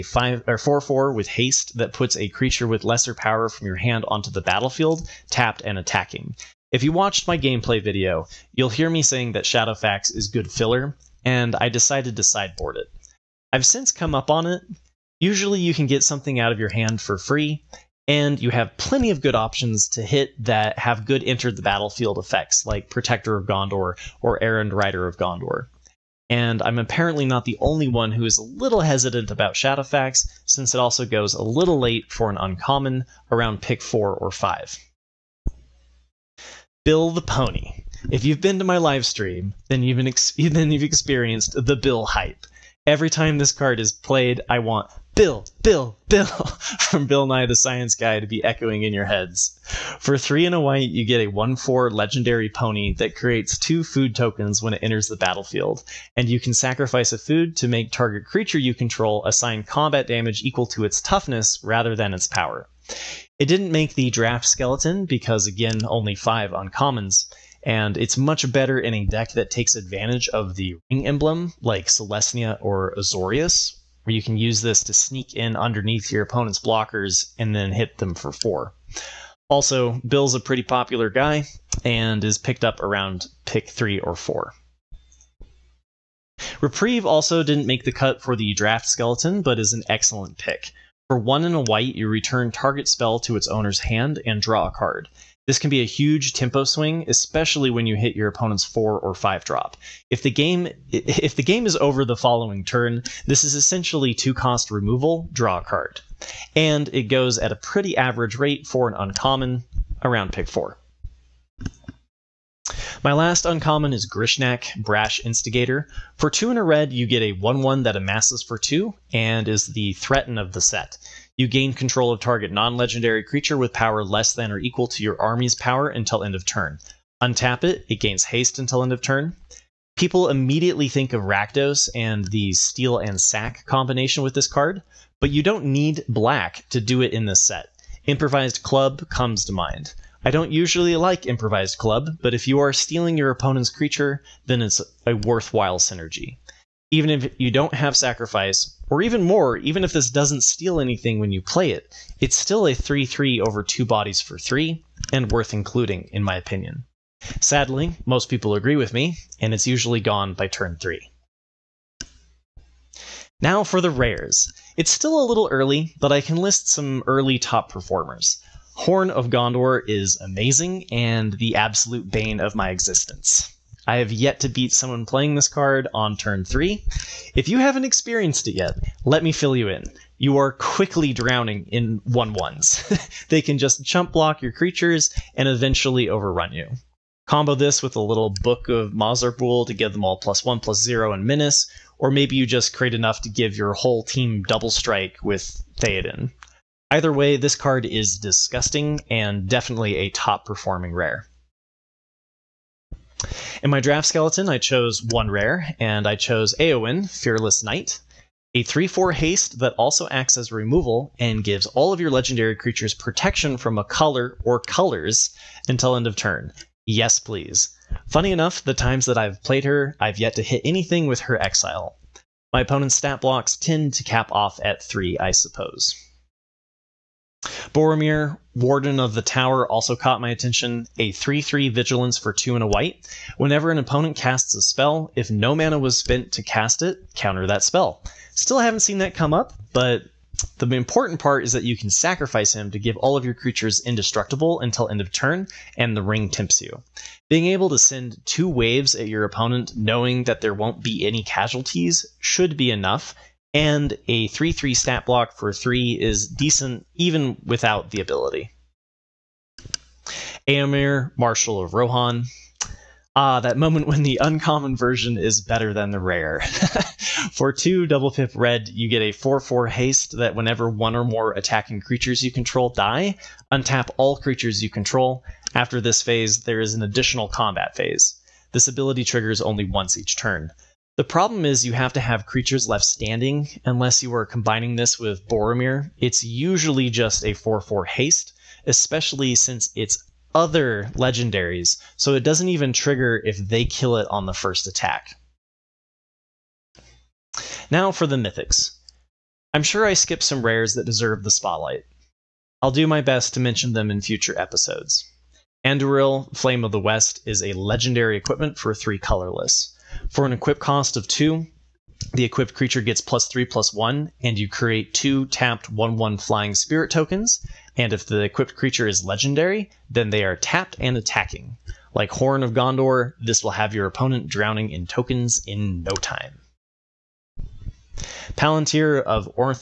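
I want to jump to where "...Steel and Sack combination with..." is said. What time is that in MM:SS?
02:12.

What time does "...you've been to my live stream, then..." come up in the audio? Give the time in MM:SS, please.
00:38.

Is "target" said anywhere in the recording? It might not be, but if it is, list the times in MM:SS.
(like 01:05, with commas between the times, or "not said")
00:57, 01:32, 02:02.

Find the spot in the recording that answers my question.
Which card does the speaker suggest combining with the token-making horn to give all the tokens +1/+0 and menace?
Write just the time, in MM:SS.
03:08.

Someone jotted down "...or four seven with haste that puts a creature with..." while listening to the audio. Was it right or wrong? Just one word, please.
wrong.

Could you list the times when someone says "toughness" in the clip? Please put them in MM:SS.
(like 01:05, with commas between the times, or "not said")
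01:01.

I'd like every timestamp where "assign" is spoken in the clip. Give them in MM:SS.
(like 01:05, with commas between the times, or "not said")
00:59.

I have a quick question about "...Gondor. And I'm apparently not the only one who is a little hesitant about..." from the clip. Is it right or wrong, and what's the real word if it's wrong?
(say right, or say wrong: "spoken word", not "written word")
right.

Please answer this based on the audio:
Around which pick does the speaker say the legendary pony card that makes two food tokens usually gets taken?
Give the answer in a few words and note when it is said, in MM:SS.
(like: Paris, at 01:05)
pick 3 or 4, at 01:23.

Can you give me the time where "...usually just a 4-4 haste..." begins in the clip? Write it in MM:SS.
04:46.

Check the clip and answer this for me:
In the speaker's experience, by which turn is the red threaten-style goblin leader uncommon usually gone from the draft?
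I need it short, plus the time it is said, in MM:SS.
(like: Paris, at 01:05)
turn 3, at 02:40.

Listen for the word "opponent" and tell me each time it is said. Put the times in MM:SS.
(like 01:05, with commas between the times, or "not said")
01:16, 01:38, 02:23, 03:42, 03:53, 04:09, 05:23.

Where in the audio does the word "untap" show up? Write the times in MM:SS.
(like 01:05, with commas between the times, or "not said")
02:07, 04:33.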